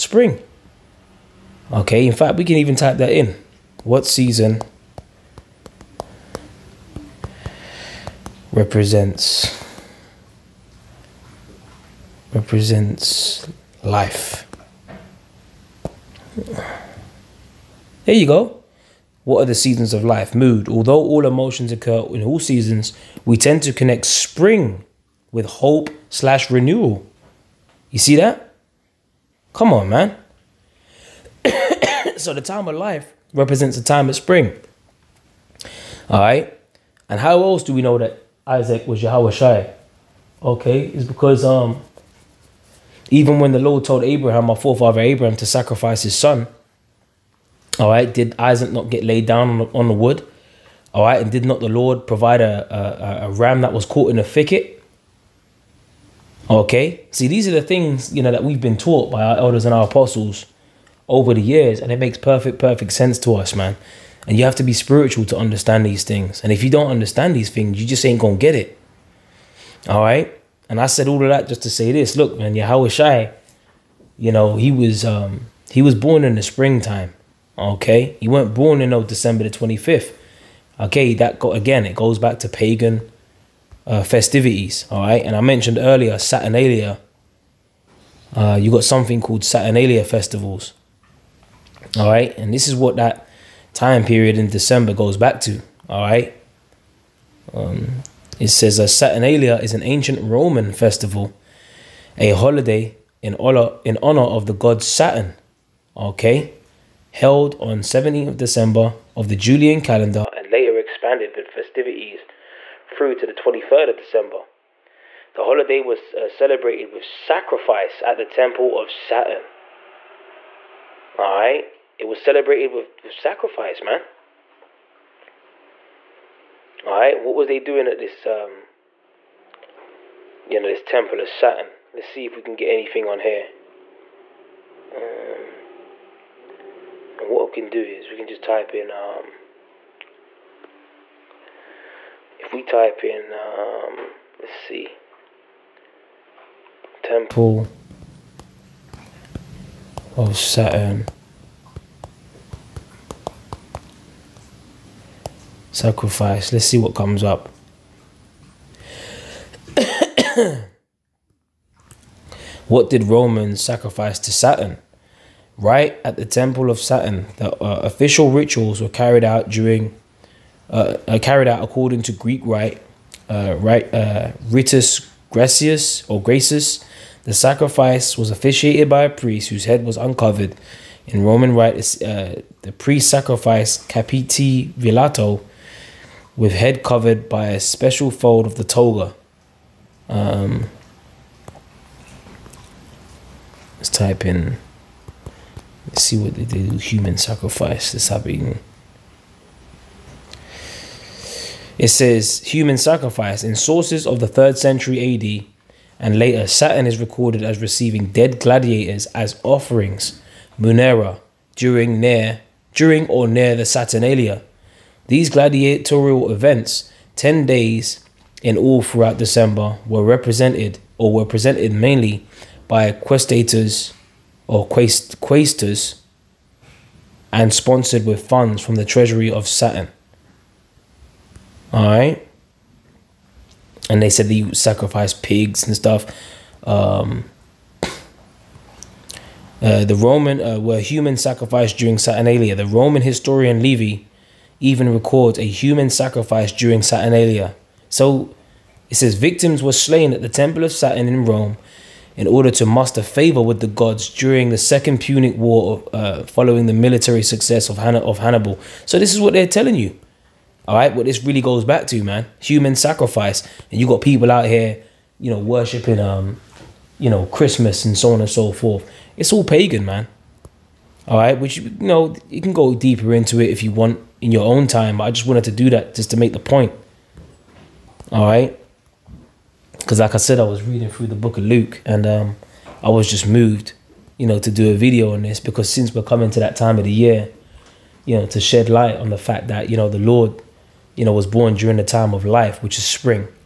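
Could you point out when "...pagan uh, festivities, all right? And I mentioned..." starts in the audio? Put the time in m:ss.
1:22.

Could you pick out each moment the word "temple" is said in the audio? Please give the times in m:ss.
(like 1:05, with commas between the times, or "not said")
1:58, 2:10, 2:27, 2:46, 4:10.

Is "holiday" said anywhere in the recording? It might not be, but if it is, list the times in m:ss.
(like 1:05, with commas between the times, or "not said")
1:42, 1:55.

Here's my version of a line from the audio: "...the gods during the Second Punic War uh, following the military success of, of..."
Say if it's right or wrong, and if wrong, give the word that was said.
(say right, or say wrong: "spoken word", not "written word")
right.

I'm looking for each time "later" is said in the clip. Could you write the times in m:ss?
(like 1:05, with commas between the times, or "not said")
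1:50, 3:26.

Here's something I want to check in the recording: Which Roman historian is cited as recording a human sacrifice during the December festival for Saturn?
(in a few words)
Livy.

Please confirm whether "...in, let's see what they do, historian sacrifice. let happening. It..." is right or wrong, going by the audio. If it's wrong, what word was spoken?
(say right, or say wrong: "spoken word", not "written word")
wrong: "human", not "historian".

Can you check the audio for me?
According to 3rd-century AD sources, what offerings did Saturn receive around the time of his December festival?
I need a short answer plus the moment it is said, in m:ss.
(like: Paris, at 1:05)
dead gladiators, at 3:28.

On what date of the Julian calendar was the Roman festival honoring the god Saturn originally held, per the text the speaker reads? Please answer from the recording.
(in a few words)
17th of December.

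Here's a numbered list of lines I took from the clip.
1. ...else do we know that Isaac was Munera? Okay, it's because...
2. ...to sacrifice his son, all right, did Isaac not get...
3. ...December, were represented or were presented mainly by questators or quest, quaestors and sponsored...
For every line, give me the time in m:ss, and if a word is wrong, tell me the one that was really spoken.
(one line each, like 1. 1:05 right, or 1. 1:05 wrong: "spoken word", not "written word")
1. 0:37 wrong: "Yahawashi", not "Munera"
2. 0:45 right
3. 3:39 right.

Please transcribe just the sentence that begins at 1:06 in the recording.
And if you don't understand these things, you just ain't gonna get it.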